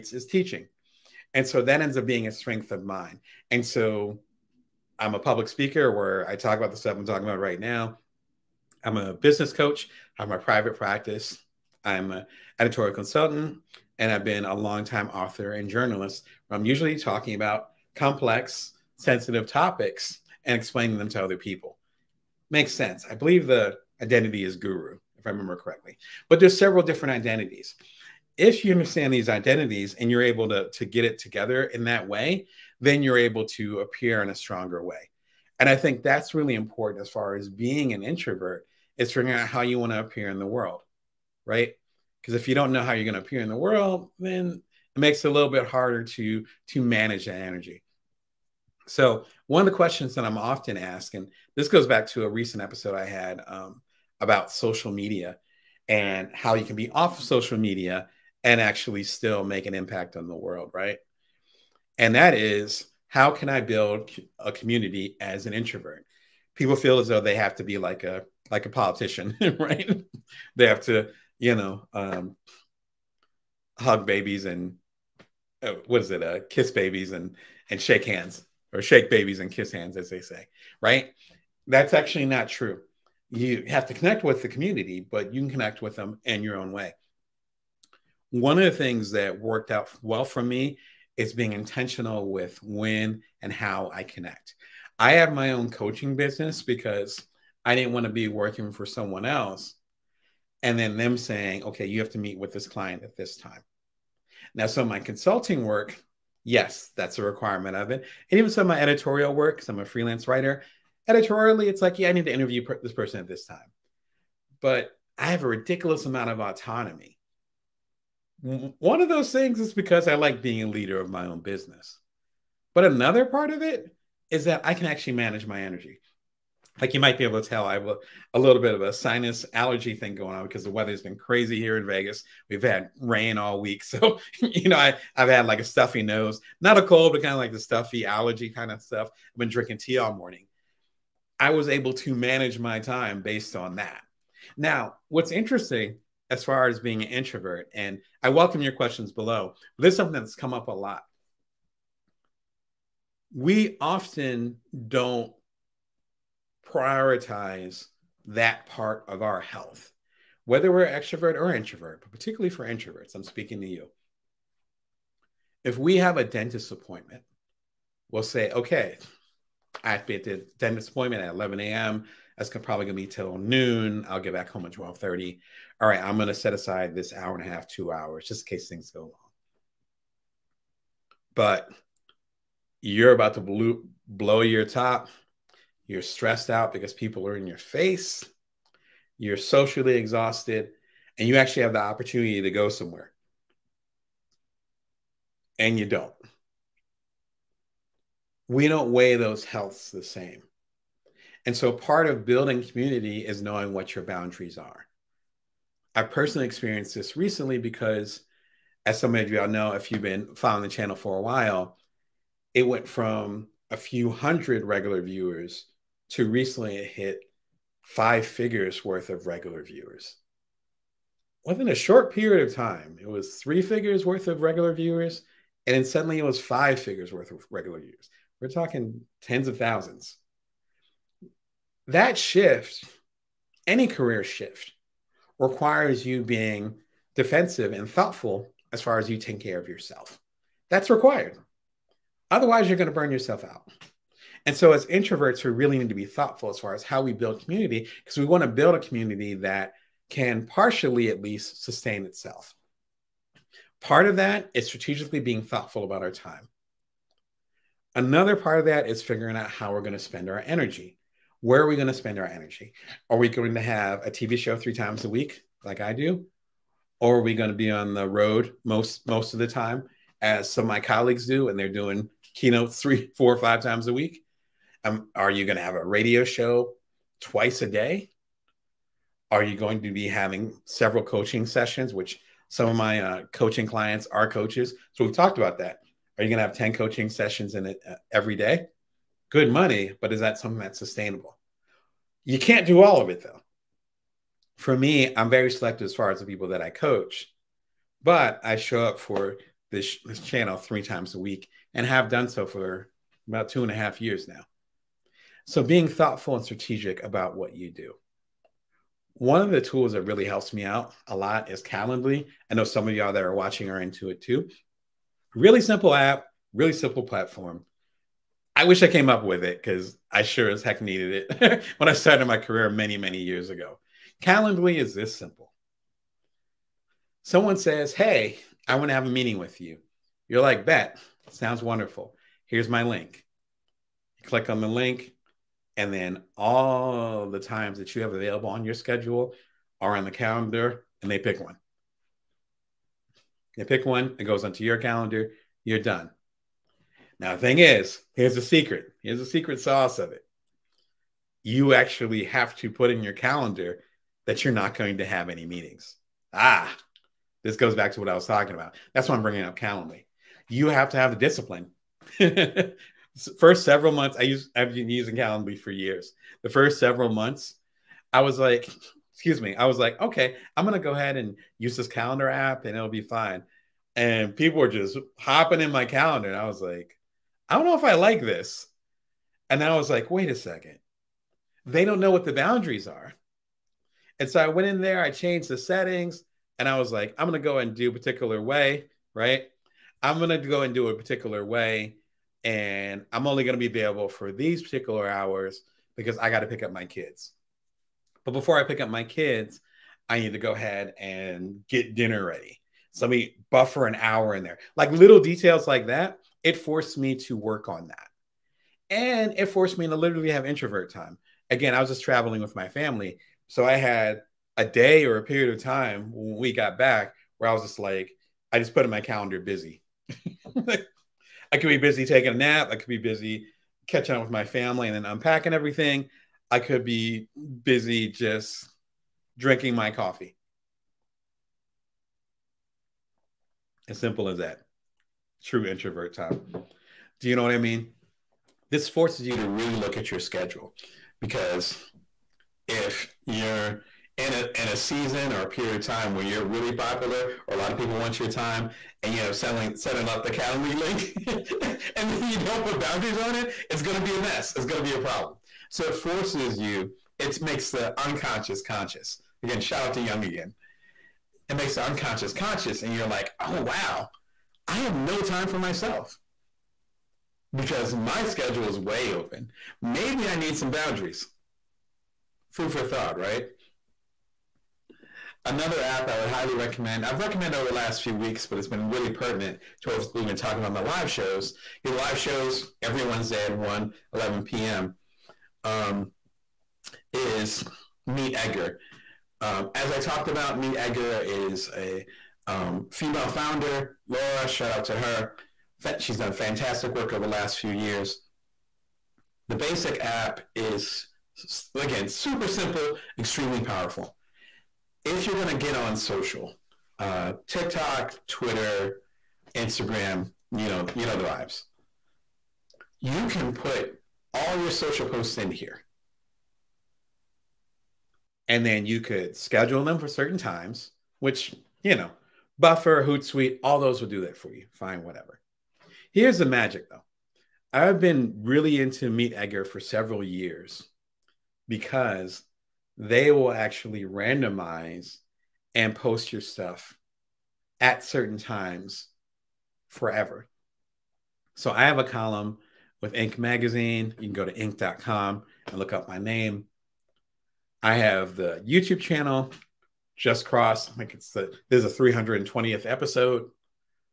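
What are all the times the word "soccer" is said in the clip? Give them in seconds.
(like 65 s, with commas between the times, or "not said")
not said.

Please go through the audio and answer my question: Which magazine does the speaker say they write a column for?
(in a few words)
Inc. Magazine.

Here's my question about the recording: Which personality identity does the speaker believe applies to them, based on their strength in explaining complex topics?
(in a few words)
guru.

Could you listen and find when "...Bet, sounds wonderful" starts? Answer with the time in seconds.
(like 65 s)
330 s.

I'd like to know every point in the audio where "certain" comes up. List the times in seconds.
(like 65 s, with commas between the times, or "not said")
520 s, 538 s.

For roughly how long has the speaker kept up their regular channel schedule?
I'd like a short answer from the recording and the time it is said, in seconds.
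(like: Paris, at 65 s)
2.5 years, at 303 s.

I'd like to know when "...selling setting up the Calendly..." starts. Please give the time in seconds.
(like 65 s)
449 s.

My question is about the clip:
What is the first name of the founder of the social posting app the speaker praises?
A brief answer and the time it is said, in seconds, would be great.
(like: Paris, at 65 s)
Laura, at 494 s.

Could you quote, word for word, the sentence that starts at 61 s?
And that is how can I build a community as an introvert?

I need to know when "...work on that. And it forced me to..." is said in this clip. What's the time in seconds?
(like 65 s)
407 s.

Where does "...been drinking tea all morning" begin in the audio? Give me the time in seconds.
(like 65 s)
139 s.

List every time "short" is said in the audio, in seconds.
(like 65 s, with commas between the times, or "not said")
221 s.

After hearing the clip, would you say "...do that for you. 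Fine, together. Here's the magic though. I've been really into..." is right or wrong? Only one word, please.
wrong.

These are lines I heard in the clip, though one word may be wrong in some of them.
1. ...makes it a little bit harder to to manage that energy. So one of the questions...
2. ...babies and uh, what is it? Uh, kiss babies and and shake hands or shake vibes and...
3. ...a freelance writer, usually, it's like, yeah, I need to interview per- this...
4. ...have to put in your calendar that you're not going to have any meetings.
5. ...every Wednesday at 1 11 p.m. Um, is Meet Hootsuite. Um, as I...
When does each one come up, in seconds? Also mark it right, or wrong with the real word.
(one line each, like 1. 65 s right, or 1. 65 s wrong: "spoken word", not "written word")
1. 44 s right
2. 74 s wrong: "babies", not "vibes"
3. 109 s wrong: "editorially", not "usually"
4. 352 s right
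5. 482 s wrong: "Edgar", not "Hootsuite".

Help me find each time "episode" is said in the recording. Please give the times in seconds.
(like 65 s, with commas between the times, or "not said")
52 s, 552 s.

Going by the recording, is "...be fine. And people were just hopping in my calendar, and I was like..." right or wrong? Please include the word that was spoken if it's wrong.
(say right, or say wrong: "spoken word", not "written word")
right.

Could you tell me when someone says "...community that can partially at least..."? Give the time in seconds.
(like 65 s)
248 s.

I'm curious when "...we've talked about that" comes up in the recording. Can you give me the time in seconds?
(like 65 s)
285 s.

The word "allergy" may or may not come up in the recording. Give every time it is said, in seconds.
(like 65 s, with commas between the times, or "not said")
129 s, 138 s.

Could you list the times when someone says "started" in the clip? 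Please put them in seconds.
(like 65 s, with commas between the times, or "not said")
321 s.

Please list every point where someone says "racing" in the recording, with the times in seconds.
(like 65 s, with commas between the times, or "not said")
not said.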